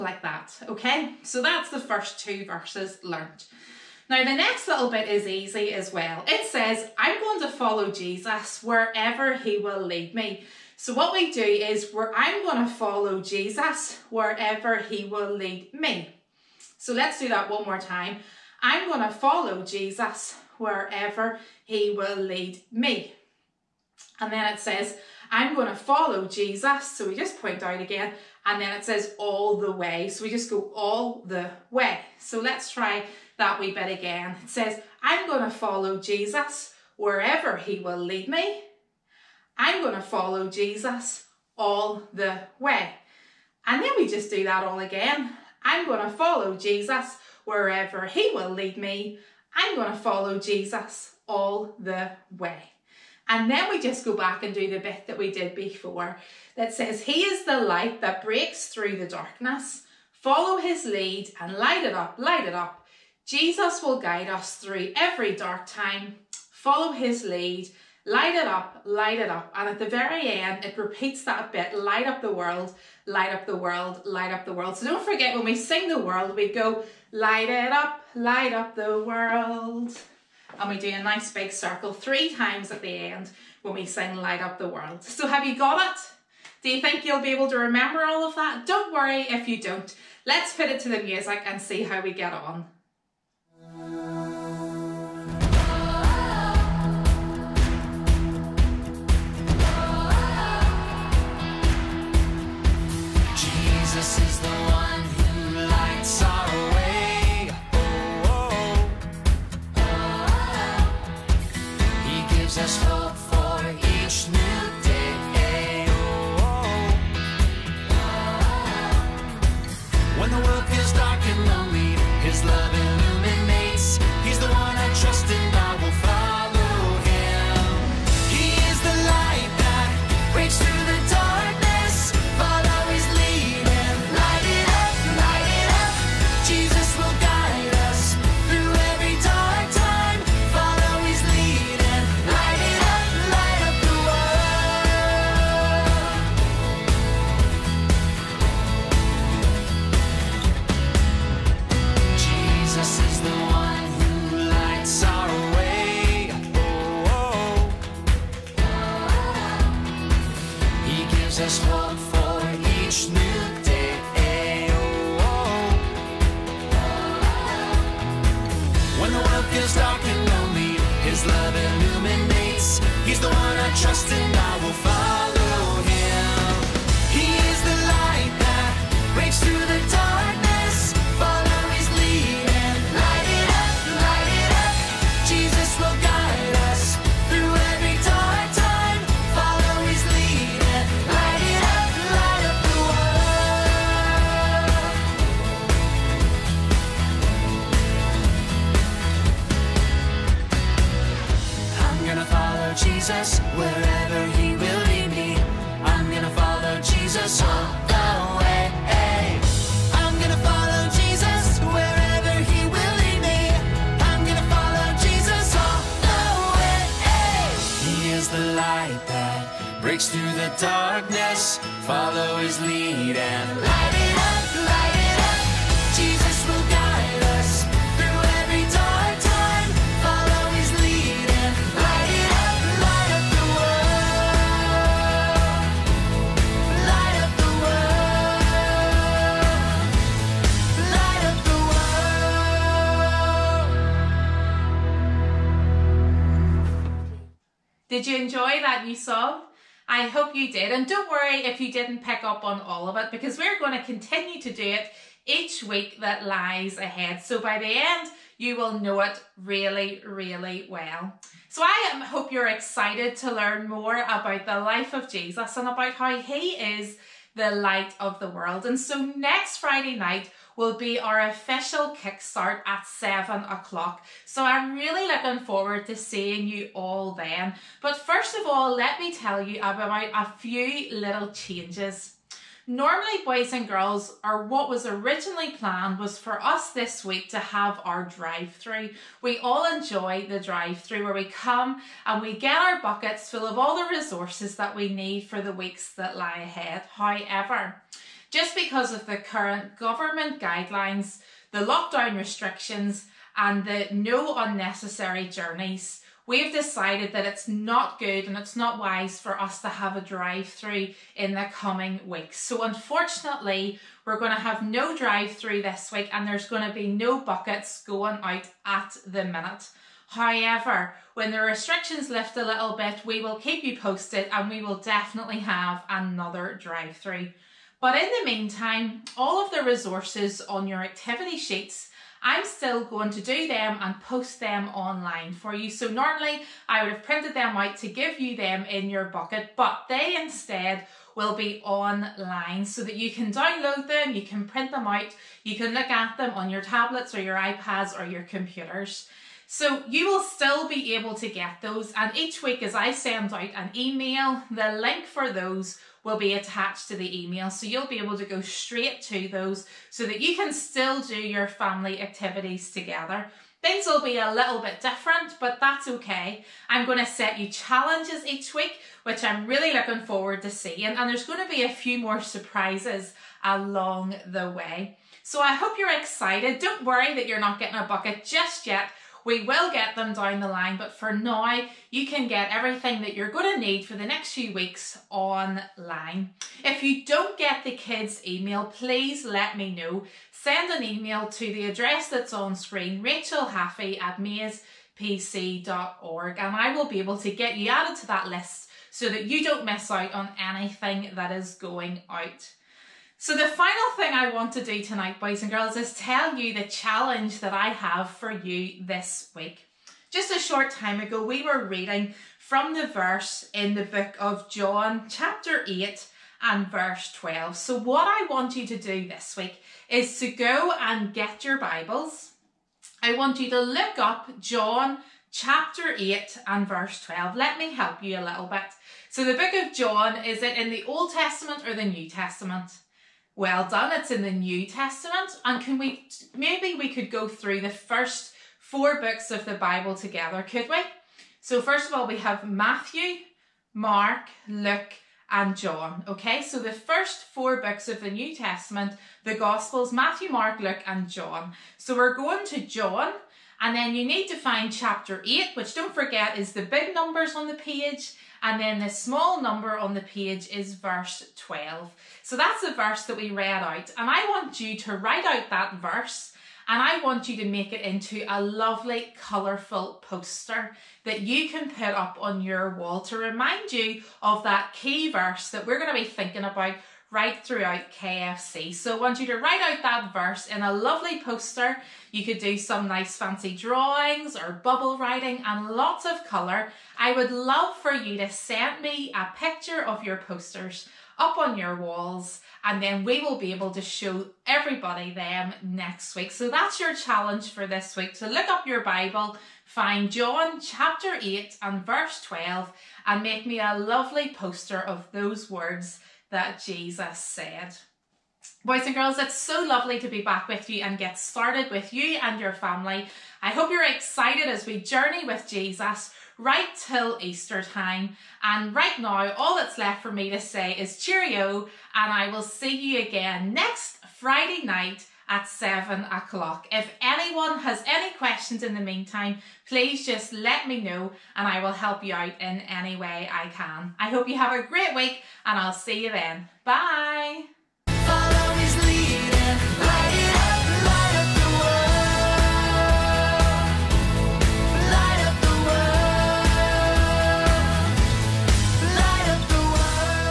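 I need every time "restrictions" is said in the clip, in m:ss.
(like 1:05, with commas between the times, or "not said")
5:02, 5:21.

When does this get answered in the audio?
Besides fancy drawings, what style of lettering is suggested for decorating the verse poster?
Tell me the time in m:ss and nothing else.
8:04.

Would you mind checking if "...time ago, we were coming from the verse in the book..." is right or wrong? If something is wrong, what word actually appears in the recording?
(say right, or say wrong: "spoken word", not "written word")
wrong: "reading", not "coming".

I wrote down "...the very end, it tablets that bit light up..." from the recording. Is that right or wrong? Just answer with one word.
wrong.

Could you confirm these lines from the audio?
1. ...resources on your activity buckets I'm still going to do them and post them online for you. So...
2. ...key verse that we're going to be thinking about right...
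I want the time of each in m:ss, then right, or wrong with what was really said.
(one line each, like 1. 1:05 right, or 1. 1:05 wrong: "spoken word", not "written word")
1. 5:29 wrong: "sheets", not "buckets"
2. 7:54 right.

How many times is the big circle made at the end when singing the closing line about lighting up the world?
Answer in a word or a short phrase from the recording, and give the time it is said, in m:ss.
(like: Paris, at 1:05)
3, at 1:21.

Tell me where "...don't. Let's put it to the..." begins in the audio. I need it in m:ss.
1:29.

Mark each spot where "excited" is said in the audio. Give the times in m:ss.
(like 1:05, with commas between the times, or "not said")
4:22, 6:15, 8:33.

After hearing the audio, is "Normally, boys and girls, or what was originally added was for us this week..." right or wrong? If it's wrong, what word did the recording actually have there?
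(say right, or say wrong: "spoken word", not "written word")
wrong: "planned", not "added".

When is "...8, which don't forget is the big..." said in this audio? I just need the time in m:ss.
7:35.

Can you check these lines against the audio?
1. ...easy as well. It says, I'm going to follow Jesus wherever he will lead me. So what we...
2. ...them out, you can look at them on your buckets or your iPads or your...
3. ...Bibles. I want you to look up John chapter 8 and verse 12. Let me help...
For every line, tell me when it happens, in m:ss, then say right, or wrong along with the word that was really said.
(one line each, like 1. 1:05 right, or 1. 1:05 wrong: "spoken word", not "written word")
1. 0:05 right
2. 5:44 wrong: "tablets", not "buckets"
3. 7:01 right.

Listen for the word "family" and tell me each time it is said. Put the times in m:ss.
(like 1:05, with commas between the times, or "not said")
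6:01, 8:32.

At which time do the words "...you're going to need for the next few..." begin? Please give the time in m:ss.
6:23.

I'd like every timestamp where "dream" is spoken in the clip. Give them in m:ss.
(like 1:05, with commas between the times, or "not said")
not said.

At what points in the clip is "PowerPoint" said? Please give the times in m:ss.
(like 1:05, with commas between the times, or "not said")
not said.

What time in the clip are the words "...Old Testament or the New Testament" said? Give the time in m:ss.
7:10.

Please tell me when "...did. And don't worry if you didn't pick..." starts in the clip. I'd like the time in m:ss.
4:10.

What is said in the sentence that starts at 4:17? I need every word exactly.
So by the end, you will know it really, really well.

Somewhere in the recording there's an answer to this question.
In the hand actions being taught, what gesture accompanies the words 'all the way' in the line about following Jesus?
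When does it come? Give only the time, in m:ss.
0:30.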